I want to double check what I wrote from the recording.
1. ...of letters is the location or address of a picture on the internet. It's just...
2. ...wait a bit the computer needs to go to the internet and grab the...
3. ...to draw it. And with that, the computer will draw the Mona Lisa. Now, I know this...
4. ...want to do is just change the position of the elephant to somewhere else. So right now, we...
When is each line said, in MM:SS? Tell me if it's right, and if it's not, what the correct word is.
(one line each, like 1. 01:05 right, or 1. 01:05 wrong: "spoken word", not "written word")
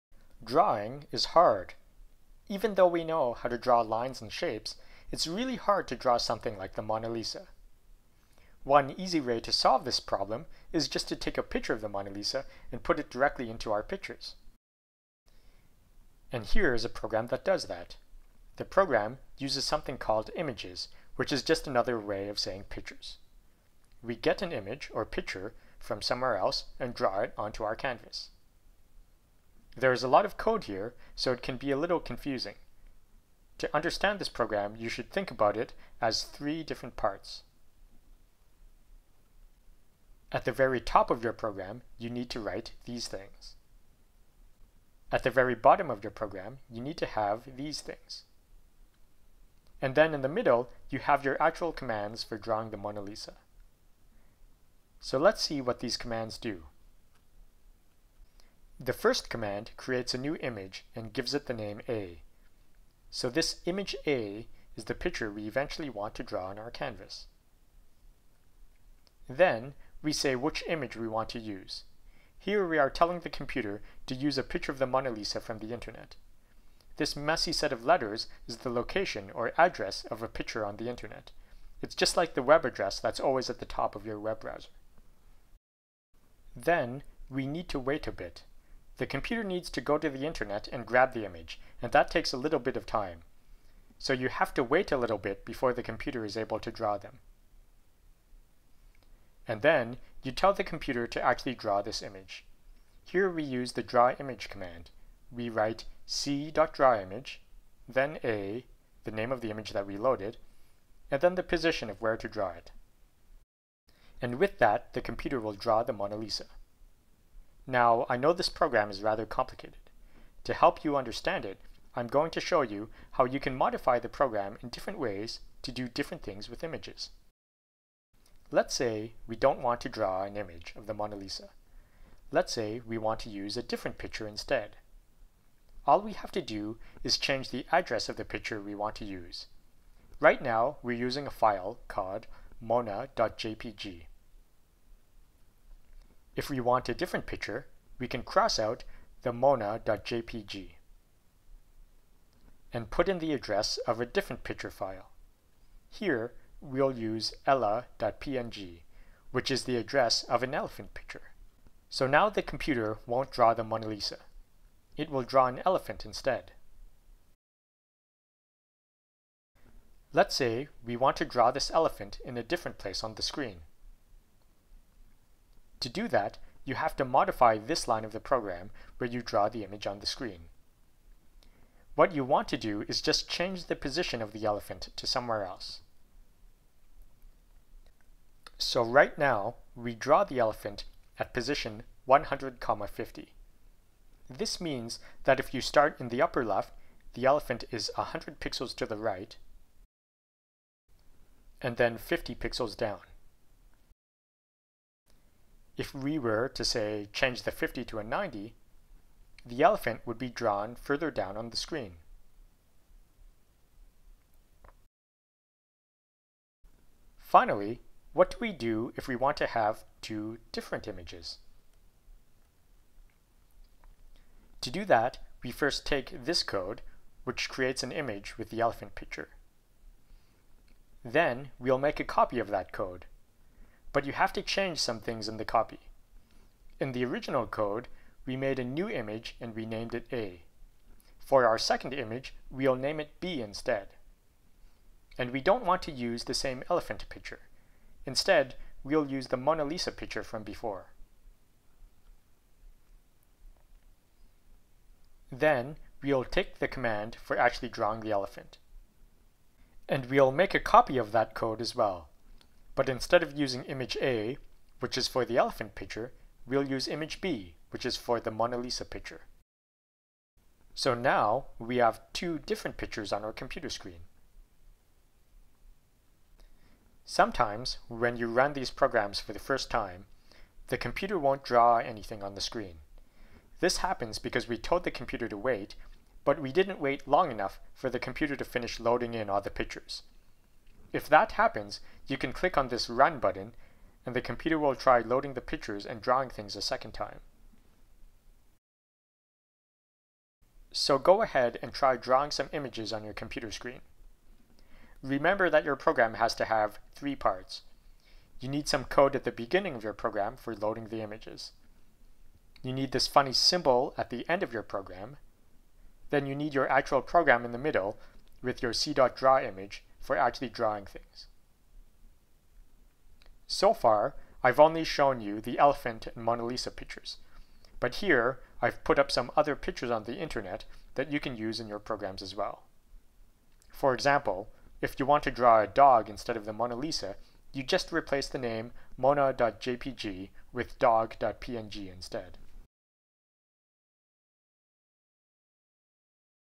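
1. 01:17 right
2. 01:27 right
3. 01:52 right
4. 03:02 right.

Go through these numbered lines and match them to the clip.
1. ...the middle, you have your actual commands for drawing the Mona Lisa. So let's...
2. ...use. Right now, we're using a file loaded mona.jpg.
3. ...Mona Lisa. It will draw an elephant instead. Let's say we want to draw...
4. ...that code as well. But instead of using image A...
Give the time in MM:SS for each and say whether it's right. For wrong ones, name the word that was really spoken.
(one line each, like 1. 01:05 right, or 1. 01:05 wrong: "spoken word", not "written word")
1. 00:50 right
2. 02:19 wrong: "called", not "loaded"
3. 02:43 right
4. 04:21 right.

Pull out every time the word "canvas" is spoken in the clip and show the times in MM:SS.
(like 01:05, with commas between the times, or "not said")
00:27, 01:06.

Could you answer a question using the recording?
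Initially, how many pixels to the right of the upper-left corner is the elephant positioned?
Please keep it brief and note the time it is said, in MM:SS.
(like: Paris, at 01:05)
100, at 03:17.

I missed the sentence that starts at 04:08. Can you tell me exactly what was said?
Instead, we'll use the Mona Lisa picture from before.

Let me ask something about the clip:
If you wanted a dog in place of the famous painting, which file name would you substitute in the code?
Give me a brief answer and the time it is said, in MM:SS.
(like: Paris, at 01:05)
dog.png, at 05:40.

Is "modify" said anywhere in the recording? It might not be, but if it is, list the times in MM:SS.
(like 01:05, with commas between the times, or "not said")
02:03, 02:57.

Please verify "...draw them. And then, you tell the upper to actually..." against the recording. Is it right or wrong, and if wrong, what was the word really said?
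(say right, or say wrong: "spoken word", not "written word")
wrong: "computer", not "upper".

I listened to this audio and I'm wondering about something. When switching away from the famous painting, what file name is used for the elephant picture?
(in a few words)
ella.png.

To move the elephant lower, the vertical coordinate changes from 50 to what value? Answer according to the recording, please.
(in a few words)
90.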